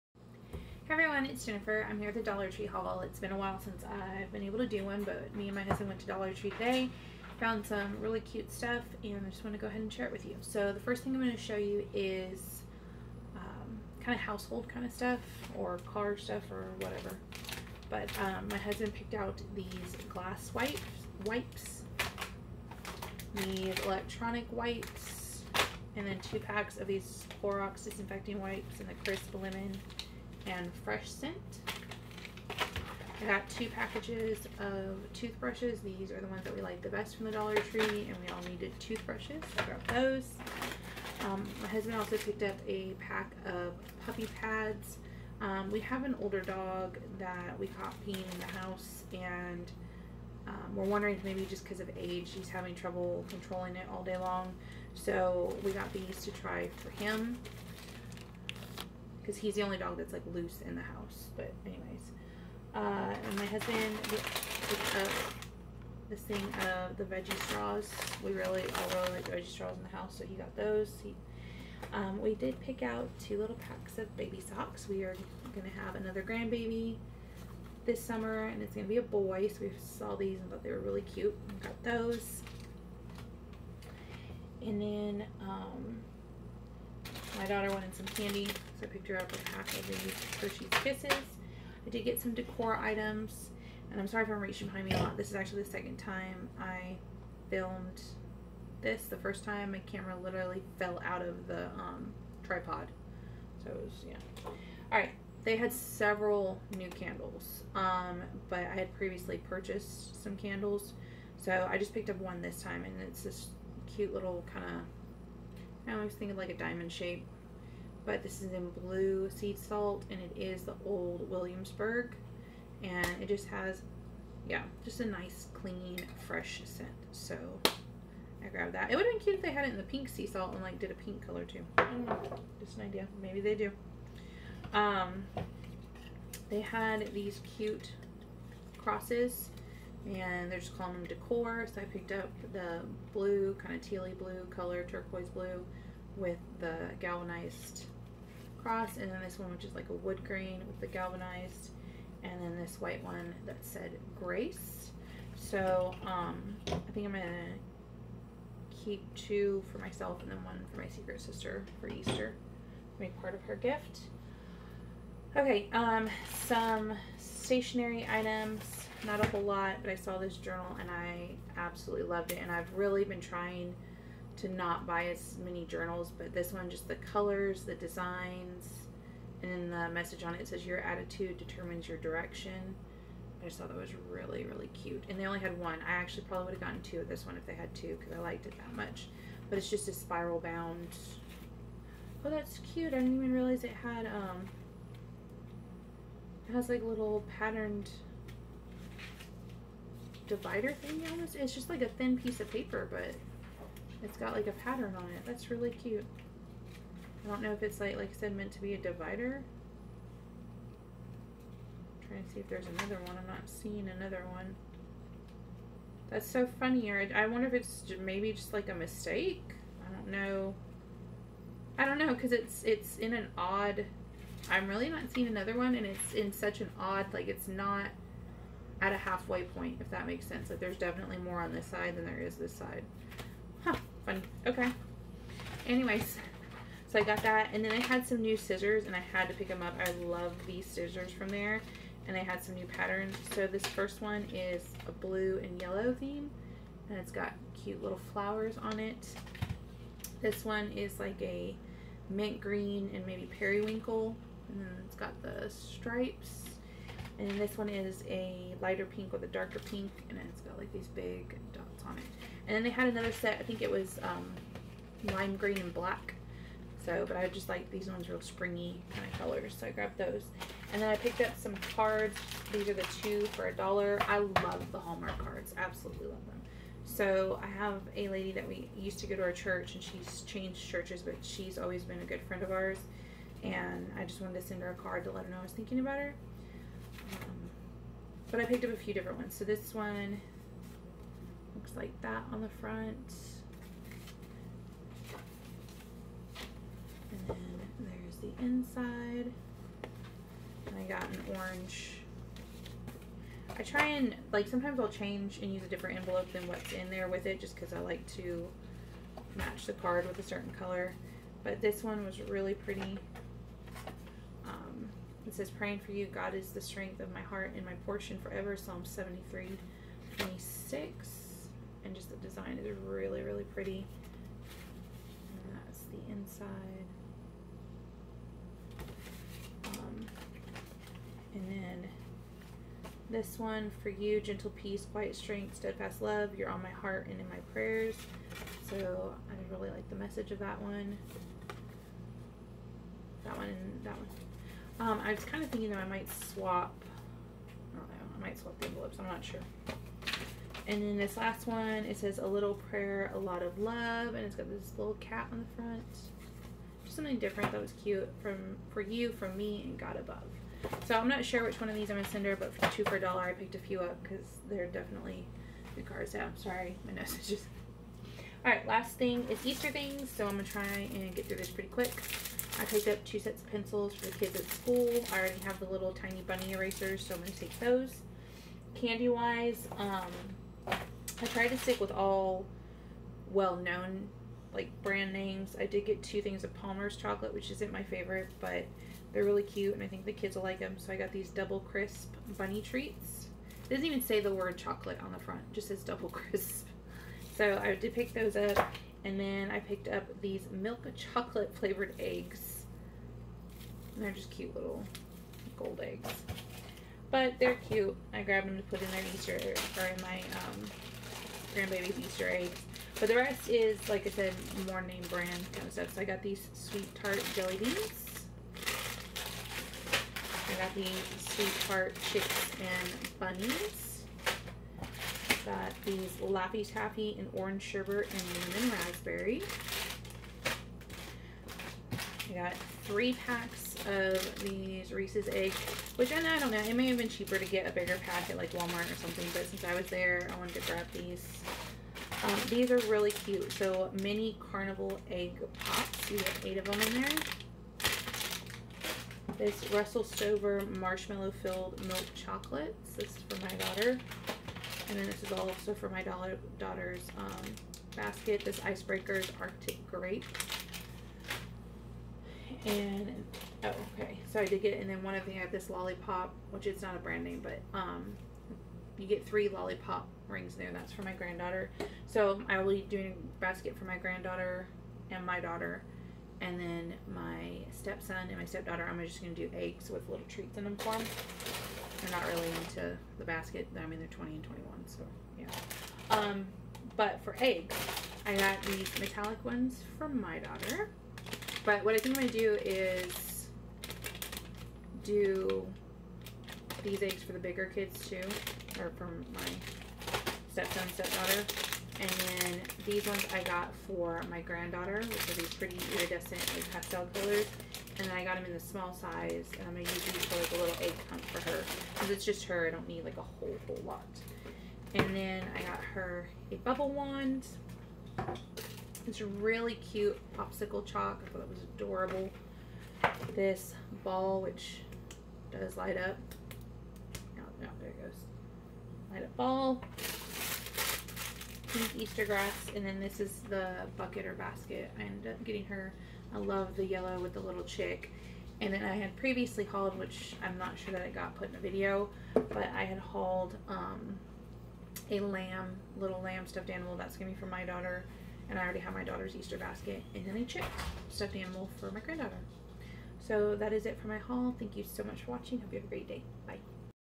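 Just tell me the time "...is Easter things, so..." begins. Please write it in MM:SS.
06:09.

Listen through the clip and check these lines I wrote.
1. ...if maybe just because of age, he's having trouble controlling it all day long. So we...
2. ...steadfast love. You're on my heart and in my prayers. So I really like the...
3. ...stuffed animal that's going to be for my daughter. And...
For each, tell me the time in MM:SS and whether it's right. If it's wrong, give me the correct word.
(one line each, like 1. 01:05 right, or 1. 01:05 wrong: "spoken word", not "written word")
1. 00:51 right
2. 05:35 right
3. 09:06 right.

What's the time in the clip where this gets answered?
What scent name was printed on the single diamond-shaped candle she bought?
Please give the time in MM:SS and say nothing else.
02:00.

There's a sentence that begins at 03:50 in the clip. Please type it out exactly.
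Like there's definitely more on this side than there is this side.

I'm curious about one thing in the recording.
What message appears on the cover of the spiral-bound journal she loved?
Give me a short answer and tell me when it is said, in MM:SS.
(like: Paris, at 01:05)
Your attitude determines your direction, at 03:00.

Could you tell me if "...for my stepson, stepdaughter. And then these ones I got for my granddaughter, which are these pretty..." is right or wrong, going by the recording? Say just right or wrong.
right.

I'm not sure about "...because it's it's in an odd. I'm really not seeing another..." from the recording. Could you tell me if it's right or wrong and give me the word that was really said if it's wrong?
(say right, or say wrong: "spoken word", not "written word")
right.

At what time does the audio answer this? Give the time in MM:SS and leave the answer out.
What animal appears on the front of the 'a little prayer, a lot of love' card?
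05:54.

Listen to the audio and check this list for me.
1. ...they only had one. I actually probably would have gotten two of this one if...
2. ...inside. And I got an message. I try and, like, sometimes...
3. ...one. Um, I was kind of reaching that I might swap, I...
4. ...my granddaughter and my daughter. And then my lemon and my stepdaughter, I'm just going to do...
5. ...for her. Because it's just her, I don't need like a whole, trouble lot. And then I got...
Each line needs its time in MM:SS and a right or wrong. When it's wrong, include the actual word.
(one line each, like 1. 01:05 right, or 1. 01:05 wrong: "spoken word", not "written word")
1. 03:05 right
2. 04:58 wrong: "orange", not "message"
3. 05:43 wrong: "thinking", not "reaching"
4. 07:53 wrong: "stepson", not "lemon"
5. 08:31 wrong: "whole", not "trouble".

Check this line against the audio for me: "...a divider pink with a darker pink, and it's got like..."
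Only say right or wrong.
wrong.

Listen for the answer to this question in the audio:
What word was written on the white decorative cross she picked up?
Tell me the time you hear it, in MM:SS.
02:34.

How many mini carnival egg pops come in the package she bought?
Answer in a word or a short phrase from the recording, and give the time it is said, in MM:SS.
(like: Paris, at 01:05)
8, at 07:26.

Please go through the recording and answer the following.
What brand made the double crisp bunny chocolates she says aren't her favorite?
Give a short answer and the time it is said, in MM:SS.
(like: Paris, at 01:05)
Palmer's, at 06:26.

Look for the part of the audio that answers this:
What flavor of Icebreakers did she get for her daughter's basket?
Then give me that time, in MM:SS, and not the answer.
07:39.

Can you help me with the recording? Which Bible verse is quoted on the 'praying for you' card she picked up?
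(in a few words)
Psalm 73:26.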